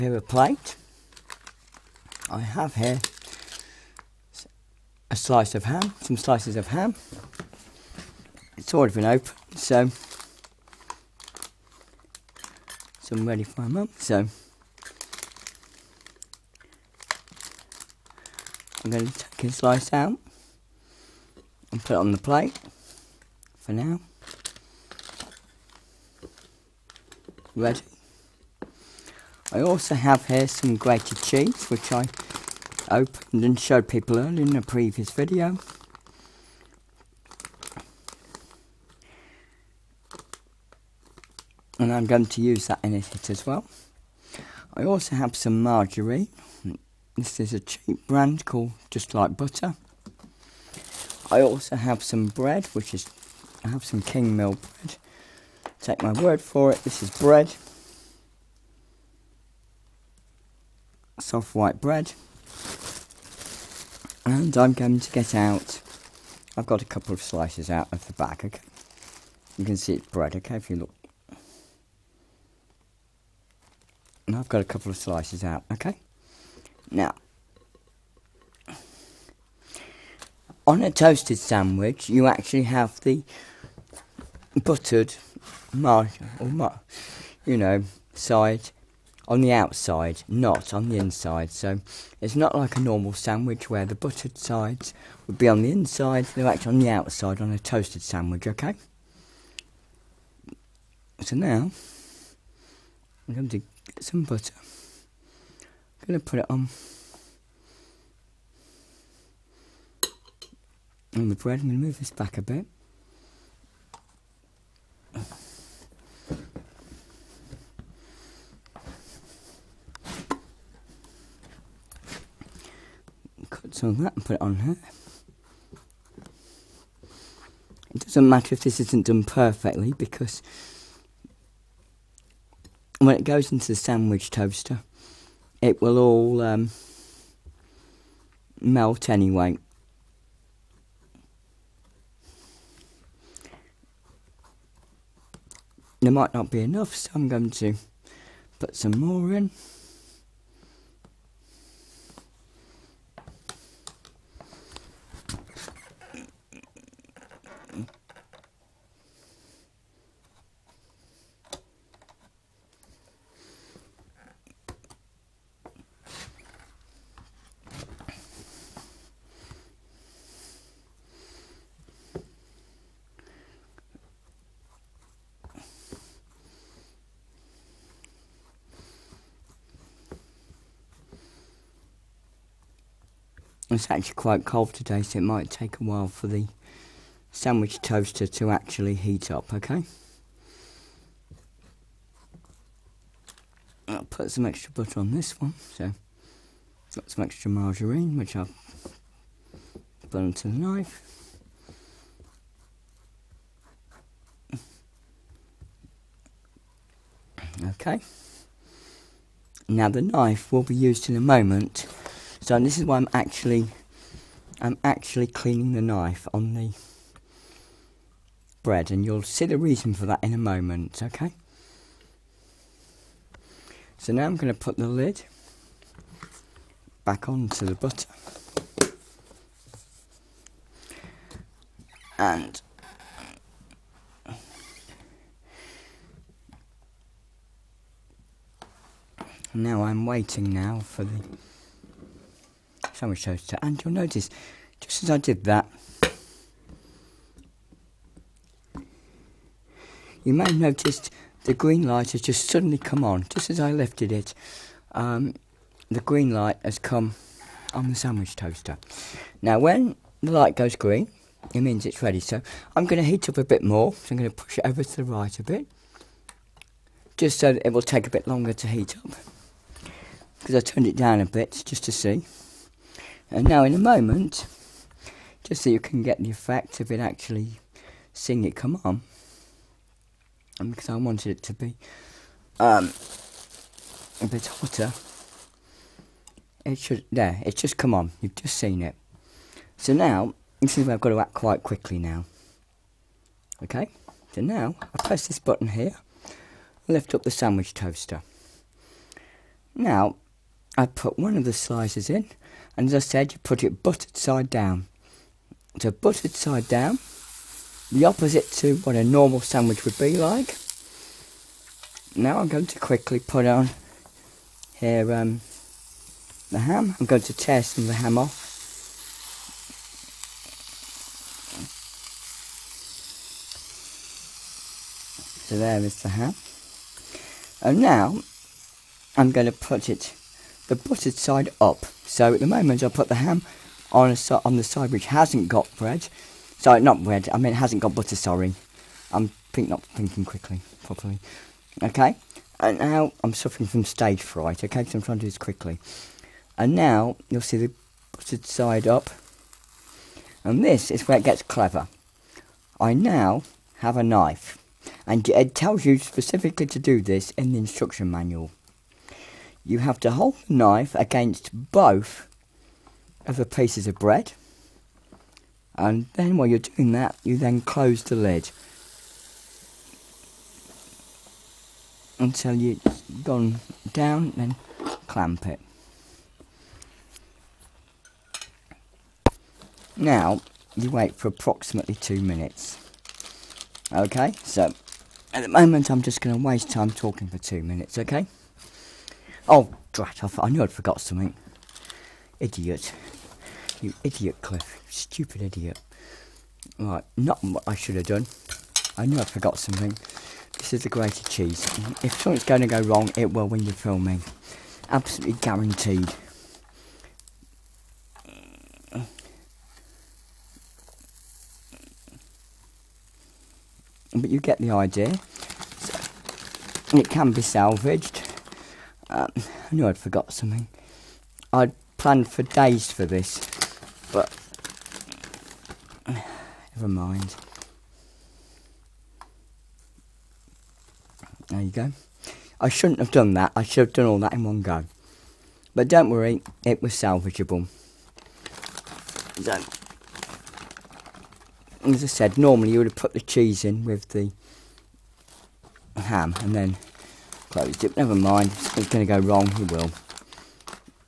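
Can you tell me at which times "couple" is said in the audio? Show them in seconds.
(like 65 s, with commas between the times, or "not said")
66 s, 74 s.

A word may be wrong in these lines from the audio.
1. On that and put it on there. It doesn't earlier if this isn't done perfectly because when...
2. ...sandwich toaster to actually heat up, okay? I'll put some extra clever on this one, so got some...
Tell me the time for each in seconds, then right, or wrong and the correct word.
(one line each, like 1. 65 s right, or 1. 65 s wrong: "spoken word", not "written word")
1. 123 s wrong: "matter", not "earlier"
2. 187 s wrong: "butter", not "clever".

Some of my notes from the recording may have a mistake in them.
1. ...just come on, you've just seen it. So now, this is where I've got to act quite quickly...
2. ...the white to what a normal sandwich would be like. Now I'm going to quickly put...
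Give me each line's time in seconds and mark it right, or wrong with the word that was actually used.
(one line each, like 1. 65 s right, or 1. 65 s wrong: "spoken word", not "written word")
1. 287 s right
2. 307 s wrong: "opposite", not "white".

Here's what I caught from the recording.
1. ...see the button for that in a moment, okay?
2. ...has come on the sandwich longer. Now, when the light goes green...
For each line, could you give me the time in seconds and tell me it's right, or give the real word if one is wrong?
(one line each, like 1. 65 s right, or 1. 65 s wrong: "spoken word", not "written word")
1. 219 s wrong: "reason", not "button"
2. 256 s wrong: "toaster", not "longer".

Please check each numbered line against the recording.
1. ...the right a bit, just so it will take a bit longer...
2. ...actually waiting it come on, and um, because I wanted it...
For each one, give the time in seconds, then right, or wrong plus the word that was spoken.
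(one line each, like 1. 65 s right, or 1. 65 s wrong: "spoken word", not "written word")
1. 264 s right
2. 276 s wrong: "seeing", not "waiting".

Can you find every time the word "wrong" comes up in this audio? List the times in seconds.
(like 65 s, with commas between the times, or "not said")
402 s, 449 s.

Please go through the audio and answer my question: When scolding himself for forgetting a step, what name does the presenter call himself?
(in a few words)
Cliff.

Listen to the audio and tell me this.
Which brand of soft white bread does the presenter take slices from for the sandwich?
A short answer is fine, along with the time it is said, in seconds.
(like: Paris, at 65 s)
Kingsmill, at 54 s.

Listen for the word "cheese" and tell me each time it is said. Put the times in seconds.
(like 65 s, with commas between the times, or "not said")
31 s, 401 s, 443 s.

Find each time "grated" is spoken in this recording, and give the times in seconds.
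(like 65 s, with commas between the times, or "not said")
30 s, 400 s.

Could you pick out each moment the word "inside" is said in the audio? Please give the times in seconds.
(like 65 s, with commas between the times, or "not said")
90 s, 95 s.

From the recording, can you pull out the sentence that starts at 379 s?
Now, you wait for approximately two minutes.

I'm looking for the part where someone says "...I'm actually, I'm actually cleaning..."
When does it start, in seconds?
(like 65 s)
212 s.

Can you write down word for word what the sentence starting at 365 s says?
And then while you're doing that, you then close the lid until it's gone down, then clamp it.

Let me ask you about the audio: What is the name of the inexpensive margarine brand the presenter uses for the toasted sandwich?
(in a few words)
Just Like Butter.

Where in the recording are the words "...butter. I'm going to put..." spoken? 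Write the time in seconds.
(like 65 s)
104 s.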